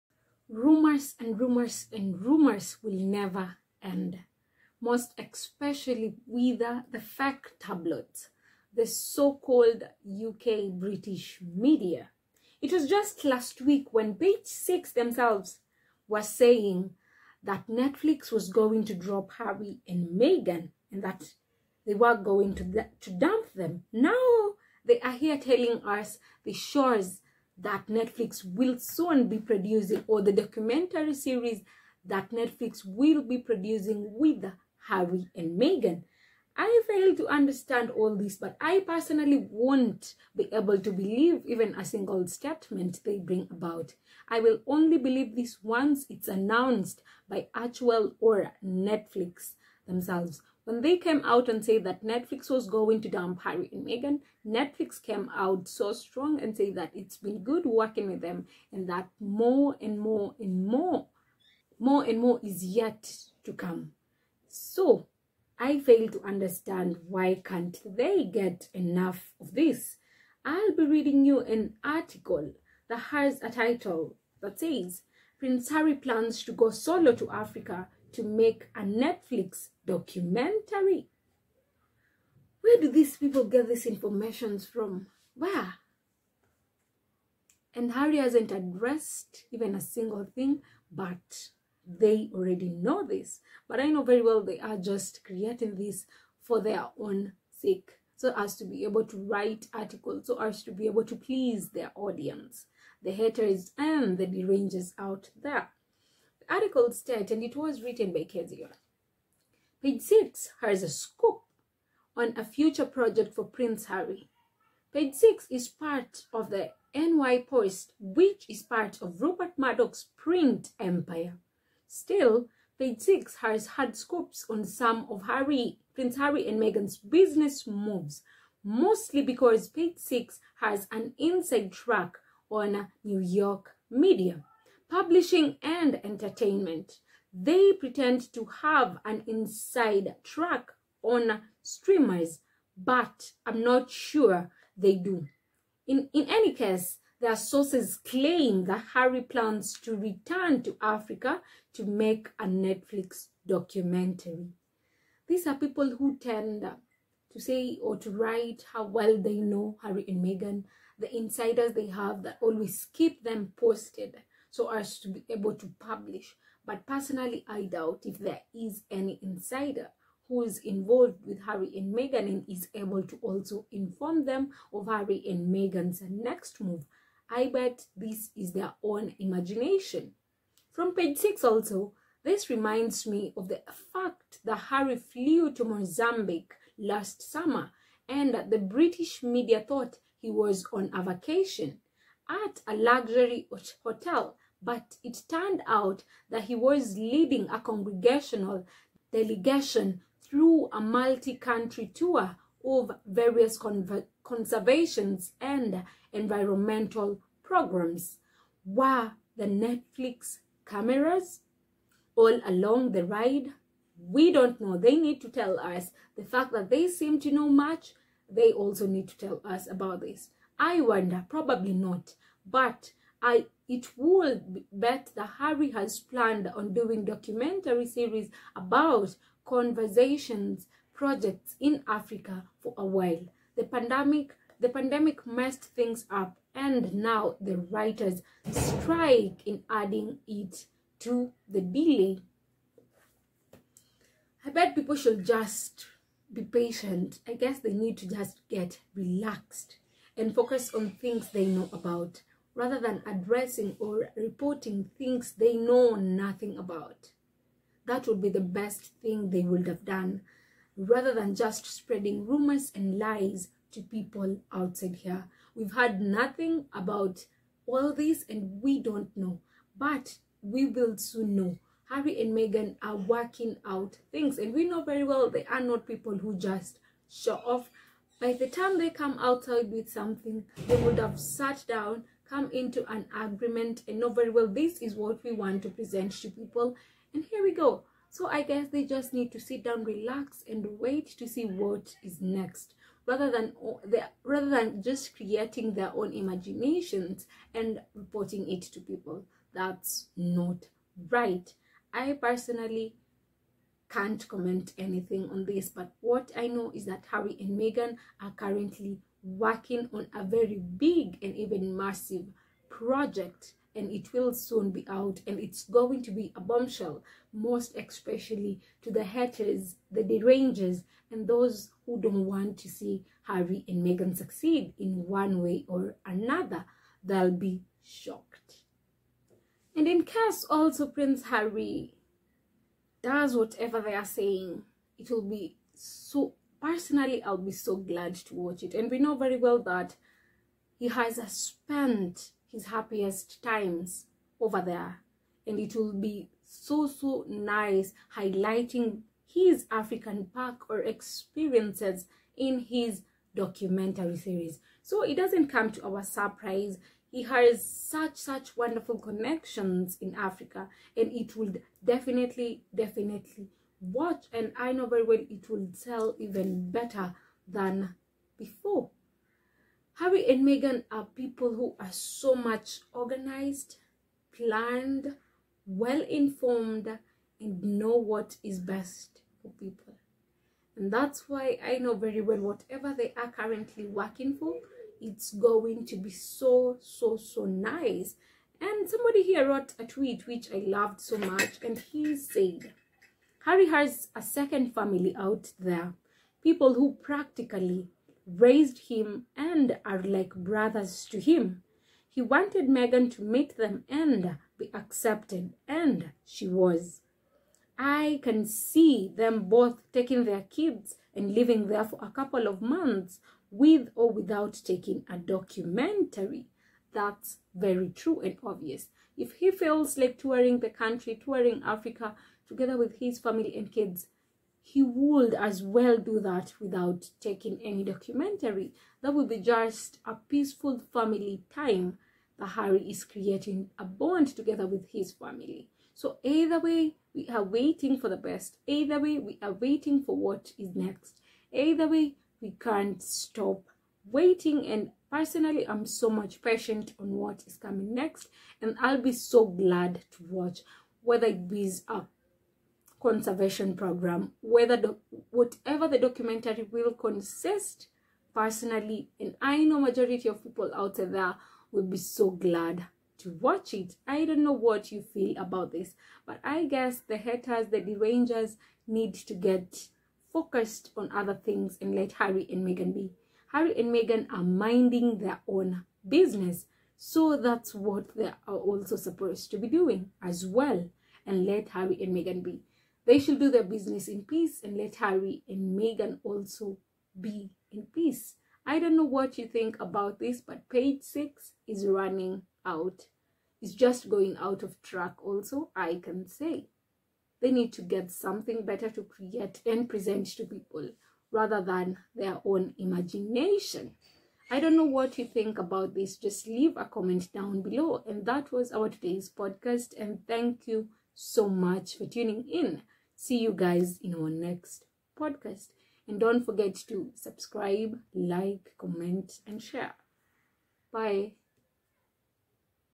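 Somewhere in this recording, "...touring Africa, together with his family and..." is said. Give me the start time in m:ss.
7:01.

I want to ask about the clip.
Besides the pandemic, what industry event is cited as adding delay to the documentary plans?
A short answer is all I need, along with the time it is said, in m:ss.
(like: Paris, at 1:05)
writers strike, at 3:57.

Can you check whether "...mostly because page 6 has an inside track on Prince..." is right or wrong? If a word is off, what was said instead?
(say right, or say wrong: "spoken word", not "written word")
wrong: "New", not "Prince".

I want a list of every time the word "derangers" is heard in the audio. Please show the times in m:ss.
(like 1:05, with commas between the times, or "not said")
1:44, 5:20, 7:47.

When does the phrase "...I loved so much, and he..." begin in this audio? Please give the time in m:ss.
6:30.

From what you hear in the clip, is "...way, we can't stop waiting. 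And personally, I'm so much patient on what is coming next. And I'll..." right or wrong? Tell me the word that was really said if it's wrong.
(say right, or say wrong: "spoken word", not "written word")
right.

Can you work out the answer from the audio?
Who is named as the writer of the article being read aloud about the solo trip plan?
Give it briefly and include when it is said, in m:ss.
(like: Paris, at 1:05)
Kaiser, at 1:48.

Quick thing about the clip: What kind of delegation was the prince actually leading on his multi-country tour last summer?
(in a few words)
congressional delegation.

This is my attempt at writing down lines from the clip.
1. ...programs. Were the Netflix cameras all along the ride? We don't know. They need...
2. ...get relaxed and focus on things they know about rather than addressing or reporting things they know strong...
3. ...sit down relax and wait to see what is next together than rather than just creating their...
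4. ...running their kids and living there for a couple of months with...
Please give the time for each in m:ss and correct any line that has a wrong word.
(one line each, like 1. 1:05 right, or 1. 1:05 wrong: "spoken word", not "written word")
1. 3:27 right
2. 4:08 wrong: "nothing", not "strong"
3. 4:49 wrong: "rather", not "together"
4. 6:49 wrong: "taking", not "running".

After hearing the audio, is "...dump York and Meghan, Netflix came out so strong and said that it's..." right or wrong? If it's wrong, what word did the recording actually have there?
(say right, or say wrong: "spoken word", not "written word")
wrong: "Harry", not "York".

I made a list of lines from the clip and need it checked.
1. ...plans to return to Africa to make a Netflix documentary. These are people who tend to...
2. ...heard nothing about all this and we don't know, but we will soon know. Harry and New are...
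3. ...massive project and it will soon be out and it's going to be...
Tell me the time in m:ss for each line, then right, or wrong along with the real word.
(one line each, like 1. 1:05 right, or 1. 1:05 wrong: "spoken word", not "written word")
1. 2:29 right
2. 4:25 wrong: "Meghan", not "New"
3. 5:11 right.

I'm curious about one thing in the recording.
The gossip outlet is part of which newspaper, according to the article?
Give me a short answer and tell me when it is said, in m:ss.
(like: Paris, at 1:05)
NY Post, at 1:56.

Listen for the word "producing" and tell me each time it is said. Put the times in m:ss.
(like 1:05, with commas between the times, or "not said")
0:29, 0:33.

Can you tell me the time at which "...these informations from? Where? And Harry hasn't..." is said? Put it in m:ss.
1:23.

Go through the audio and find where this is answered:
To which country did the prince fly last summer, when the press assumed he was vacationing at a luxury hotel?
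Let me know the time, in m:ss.
3:05.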